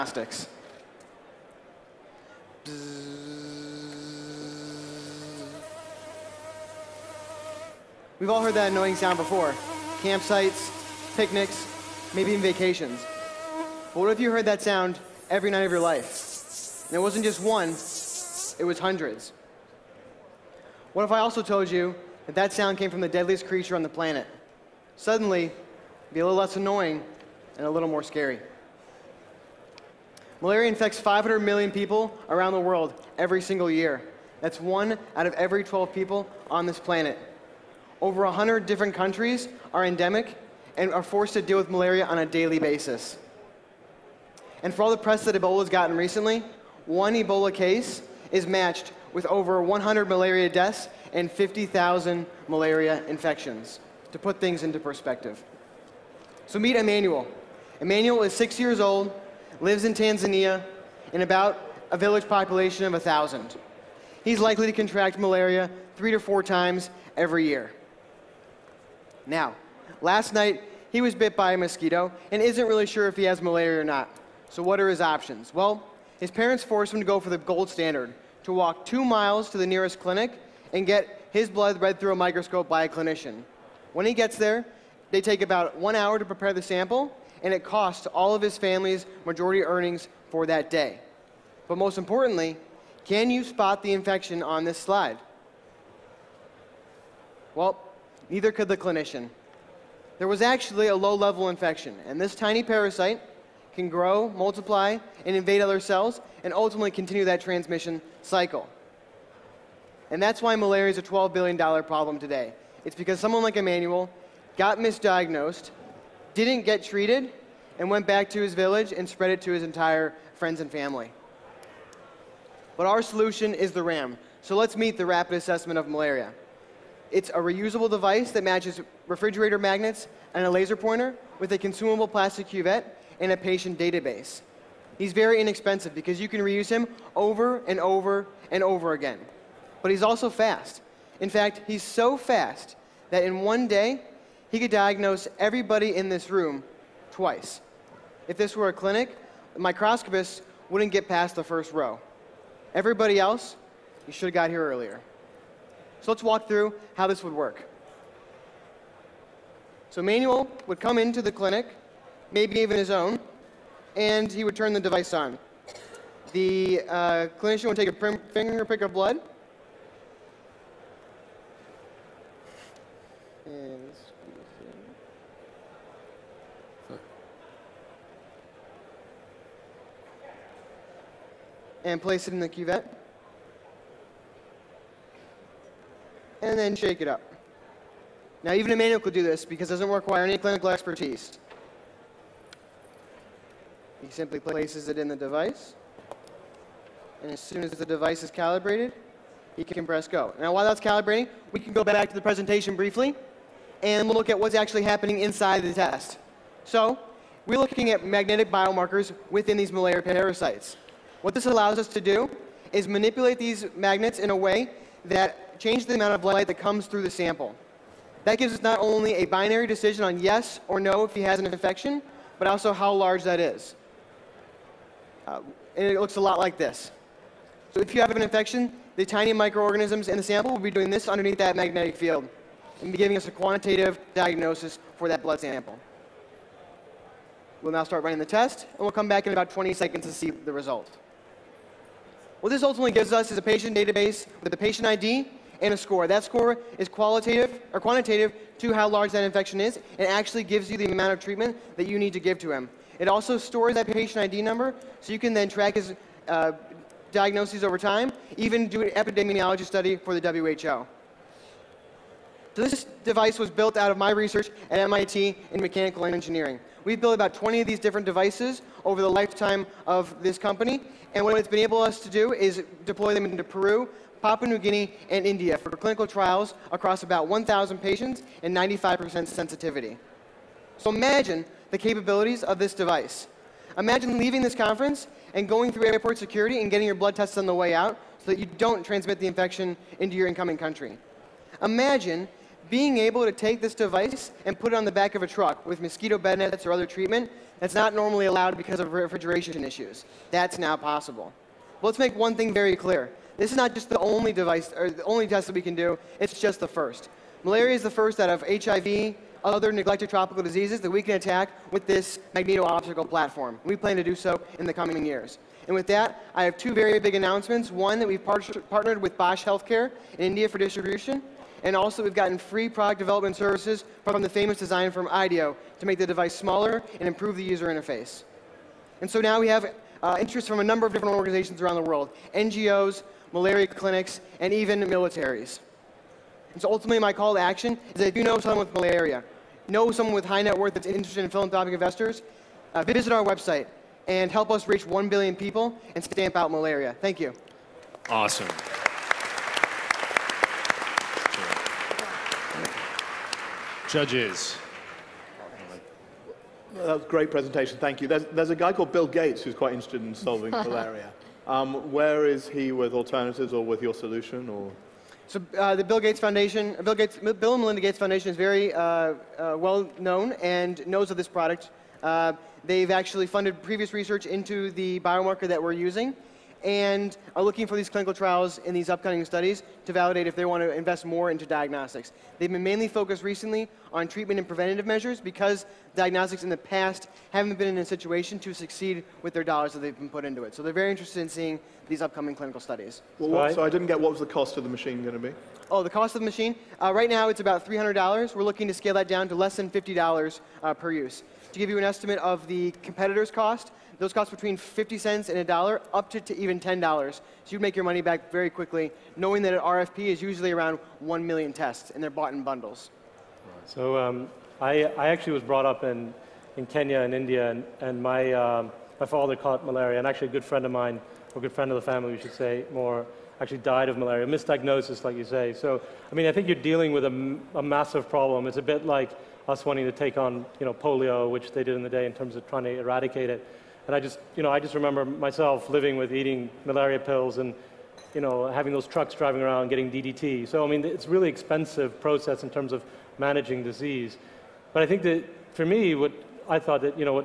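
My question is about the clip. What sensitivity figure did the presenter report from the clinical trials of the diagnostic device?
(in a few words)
95%.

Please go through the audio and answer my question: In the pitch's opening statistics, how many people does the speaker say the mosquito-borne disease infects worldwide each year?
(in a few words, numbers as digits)
500 million.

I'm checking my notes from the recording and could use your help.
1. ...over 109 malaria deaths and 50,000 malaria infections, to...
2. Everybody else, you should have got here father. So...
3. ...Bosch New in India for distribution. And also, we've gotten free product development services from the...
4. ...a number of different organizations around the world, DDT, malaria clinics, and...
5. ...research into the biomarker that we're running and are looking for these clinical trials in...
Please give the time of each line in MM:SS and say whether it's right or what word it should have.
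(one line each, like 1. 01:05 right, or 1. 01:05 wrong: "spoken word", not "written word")
1. 00:49 wrong: "100", not "109"
2. 02:32 wrong: "earlier", not "father"
3. 05:19 wrong: "Healthcare", not "New"
4. 05:30 wrong: "NGOs", not "DDT"
5. 06:13 wrong: "using", not "running".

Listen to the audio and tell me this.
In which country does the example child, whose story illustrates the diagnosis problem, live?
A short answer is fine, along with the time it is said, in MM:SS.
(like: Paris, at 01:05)
Tanzania, at 00:59.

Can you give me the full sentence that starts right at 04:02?
What this ultimately gives us is a patient database with a patient ID and a score.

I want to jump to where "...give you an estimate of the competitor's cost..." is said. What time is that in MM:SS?
06:41.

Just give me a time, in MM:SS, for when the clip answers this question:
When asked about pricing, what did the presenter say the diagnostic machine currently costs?
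06:37.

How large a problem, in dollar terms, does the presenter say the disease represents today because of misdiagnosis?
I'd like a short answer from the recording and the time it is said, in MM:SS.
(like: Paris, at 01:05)
$12 billion, at 01:51.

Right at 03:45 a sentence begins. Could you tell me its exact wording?
Uh, and it looks a lot like this.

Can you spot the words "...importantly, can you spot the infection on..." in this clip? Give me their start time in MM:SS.
01:31.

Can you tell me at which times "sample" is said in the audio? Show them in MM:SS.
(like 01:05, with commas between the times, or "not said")
01:26, 03:37, 03:50, 03:55.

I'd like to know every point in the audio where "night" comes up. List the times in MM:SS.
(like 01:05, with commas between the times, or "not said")
00:15, 01:10.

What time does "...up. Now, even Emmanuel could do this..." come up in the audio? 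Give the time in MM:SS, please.
03:07.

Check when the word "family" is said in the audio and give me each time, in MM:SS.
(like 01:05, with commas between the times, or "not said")
01:28, 02:00, 07:01.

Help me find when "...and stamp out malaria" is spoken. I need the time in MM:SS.
05:45.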